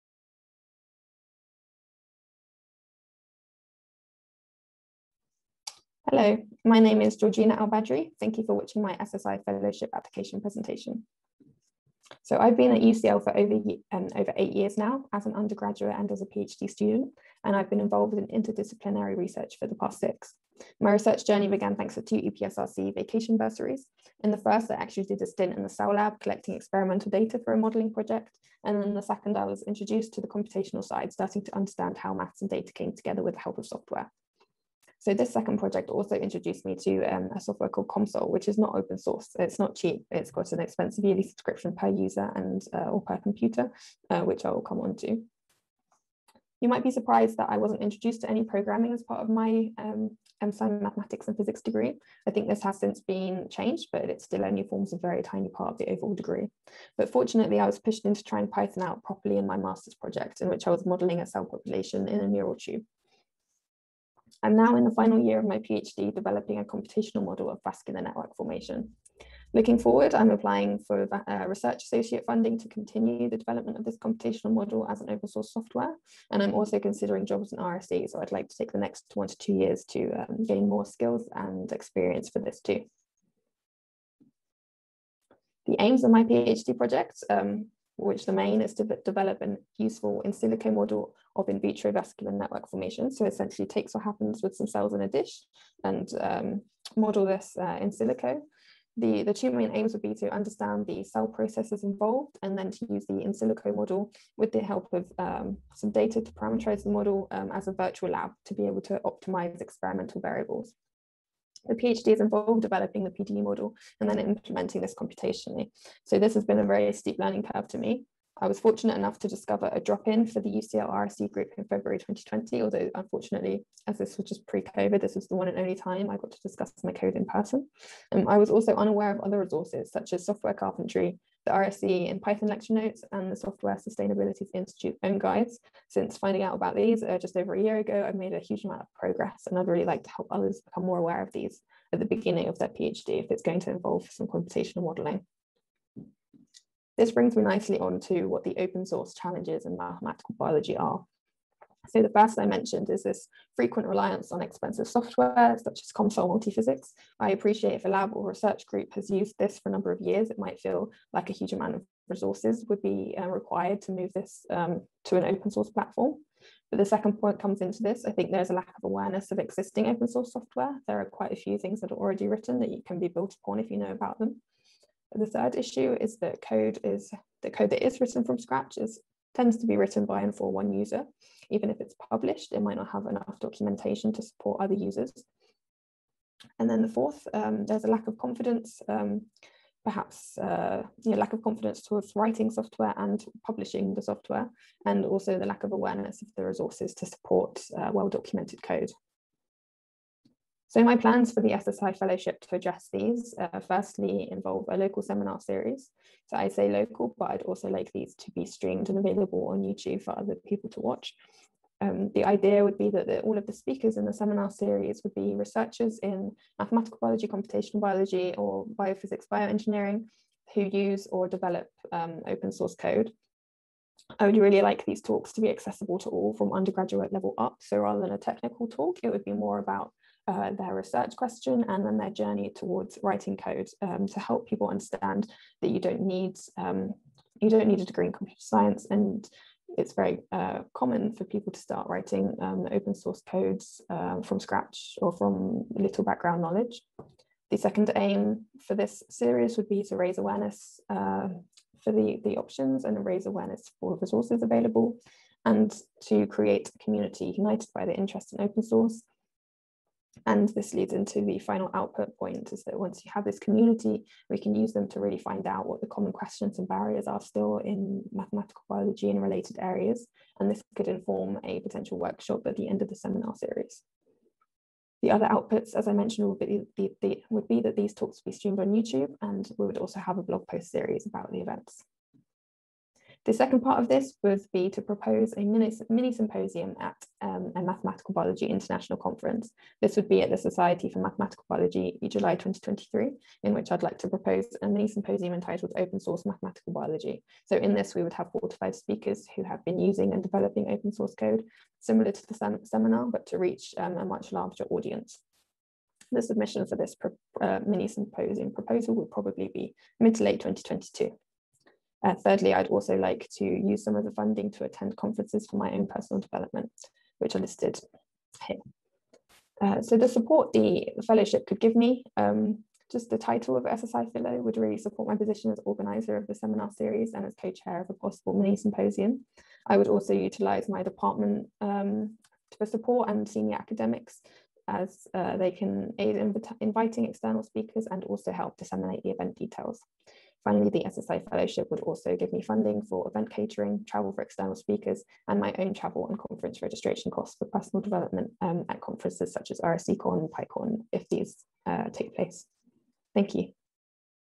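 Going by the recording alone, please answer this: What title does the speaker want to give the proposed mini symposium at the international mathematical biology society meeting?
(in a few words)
Open Source Mathematical Biology.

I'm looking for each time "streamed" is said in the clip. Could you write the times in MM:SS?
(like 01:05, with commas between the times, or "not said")
03:28, 04:38.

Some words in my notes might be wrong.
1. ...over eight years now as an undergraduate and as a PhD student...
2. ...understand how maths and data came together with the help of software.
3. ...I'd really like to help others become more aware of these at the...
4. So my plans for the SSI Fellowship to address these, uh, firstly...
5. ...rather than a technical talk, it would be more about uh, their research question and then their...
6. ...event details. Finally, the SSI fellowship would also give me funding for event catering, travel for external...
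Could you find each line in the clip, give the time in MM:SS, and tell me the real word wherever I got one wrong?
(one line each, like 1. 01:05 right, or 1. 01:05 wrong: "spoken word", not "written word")
1. 00:14 right
2. 00:31 right
3. 02:19 right
4. 03:20 right
5. 03:47 right
6. 05:39 right.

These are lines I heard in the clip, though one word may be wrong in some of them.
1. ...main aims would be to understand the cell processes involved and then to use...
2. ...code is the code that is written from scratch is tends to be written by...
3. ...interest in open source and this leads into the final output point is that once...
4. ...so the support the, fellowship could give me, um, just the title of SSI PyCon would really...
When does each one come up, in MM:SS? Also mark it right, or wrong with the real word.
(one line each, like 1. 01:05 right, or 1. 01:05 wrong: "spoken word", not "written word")
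1. 01:39 right
2. 02:56 right
3. 04:17 right
4. 05:19 wrong: "Fellow", not "PyCon".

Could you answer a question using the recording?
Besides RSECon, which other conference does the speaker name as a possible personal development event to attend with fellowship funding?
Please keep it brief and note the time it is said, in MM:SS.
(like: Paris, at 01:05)
PyCon, at 05:50.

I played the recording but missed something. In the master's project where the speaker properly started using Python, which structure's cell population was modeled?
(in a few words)
neural tube.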